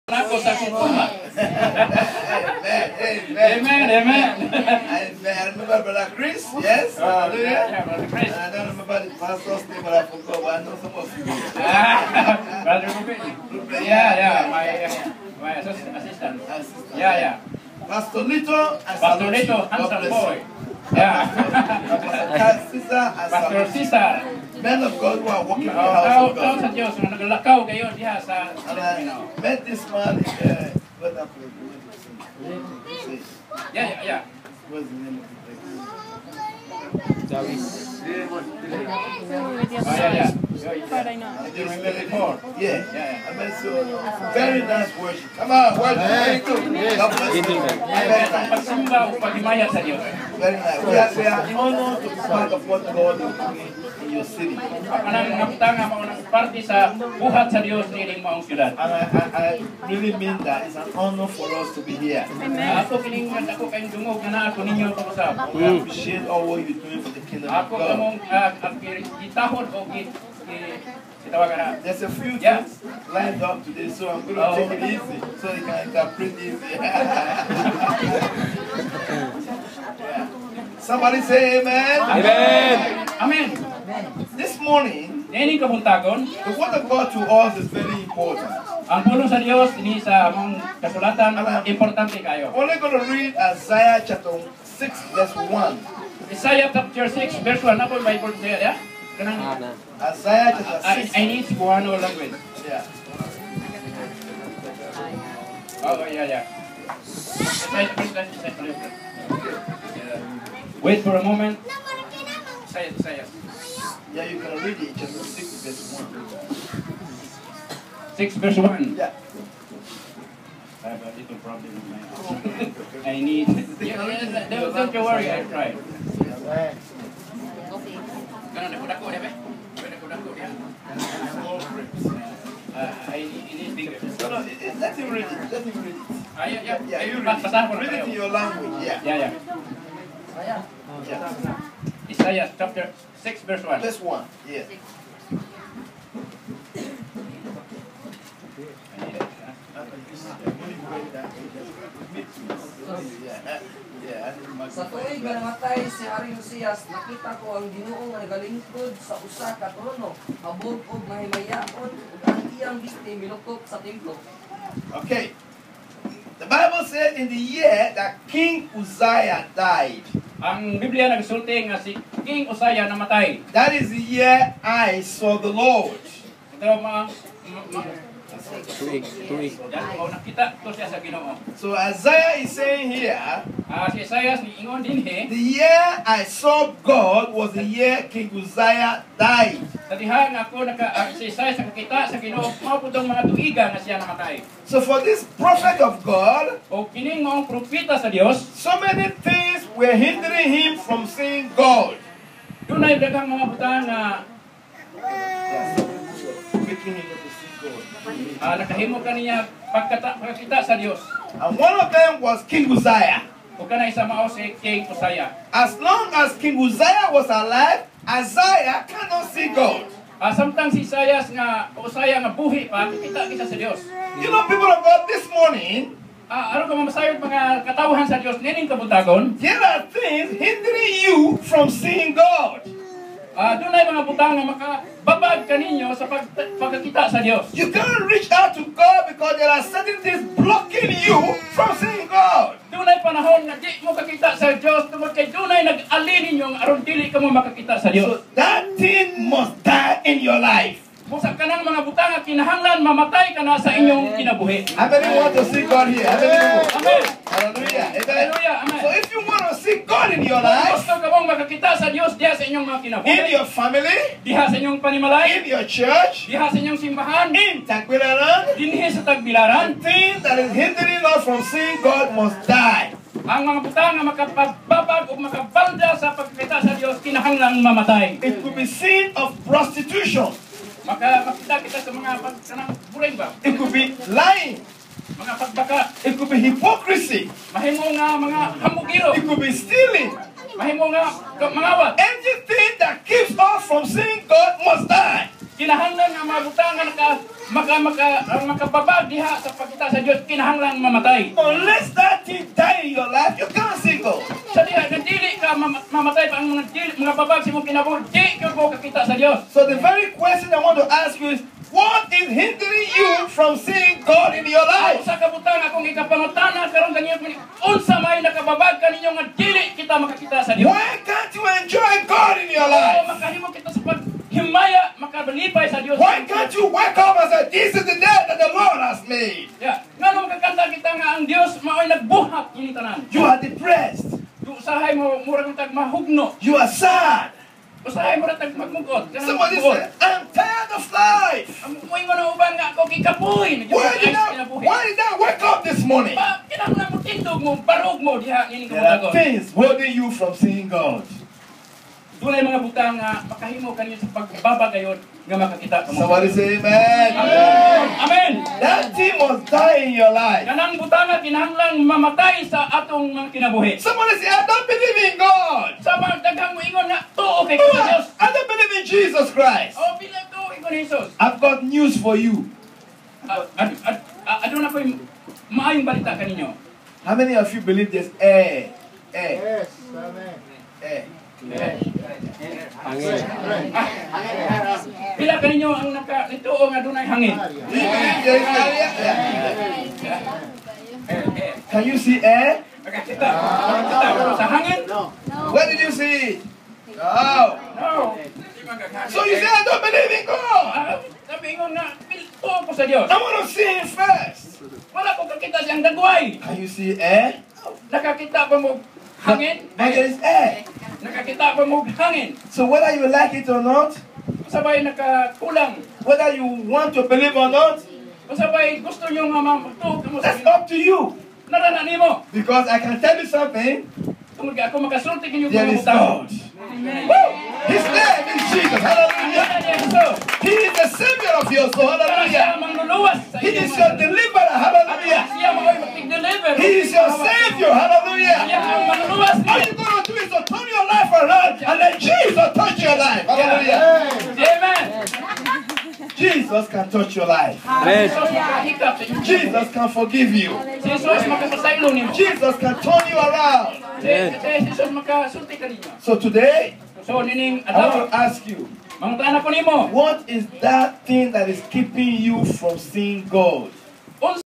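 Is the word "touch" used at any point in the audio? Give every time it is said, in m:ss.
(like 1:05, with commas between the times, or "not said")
7:22, 7:26.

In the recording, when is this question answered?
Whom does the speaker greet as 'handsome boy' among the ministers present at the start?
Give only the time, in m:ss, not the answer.
0:18.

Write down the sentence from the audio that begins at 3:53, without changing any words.
Uh, doon ay mga butang na makababag kaninyo sa pag pagkakita sa Diyos.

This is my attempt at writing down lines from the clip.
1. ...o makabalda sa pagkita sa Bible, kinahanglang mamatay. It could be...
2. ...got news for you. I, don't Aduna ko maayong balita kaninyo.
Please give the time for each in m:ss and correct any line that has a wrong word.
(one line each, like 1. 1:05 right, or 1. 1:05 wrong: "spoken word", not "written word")
1. 4:35 wrong: "Diyos", not "Bible"
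2. 6:11 right.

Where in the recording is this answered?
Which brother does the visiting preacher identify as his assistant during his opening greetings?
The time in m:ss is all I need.
0:11.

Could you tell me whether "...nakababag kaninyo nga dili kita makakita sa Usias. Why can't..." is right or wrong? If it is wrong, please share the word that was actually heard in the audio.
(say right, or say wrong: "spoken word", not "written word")
wrong: "Dios", not "Usias".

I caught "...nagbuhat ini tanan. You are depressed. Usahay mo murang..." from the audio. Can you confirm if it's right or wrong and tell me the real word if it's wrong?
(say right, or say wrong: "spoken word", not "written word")
right.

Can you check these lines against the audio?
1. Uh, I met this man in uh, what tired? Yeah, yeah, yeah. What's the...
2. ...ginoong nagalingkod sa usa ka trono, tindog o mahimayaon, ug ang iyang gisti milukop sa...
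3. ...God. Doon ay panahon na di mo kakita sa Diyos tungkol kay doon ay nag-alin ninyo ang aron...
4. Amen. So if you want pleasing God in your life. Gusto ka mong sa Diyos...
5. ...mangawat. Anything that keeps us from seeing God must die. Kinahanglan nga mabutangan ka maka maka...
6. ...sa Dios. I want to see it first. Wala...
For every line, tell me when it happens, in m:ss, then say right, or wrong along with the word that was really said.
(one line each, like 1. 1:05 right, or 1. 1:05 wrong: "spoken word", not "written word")
1. 0:26 wrong: "happened", not "tired"
2. 2:37 wrong: "habog", not "tindog"
3. 4:02 right
4. 4:18 right
5. 4:51 right
6. 6:42 right.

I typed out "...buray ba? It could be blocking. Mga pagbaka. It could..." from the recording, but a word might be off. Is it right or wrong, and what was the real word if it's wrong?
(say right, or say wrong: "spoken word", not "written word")
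wrong: "lying", not "blocking".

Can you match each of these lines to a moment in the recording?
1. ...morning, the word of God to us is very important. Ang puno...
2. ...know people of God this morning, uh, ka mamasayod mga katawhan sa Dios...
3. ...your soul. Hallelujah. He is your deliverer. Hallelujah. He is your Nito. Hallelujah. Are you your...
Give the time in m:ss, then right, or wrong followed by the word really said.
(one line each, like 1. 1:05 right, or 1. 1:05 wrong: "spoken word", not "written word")
1. 1:24 right
2. 3:44 right
3. 7:11 wrong: "Savior", not "Nito".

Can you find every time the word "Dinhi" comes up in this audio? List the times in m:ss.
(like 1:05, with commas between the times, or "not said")
4:28.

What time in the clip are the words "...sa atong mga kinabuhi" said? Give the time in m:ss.
6:02.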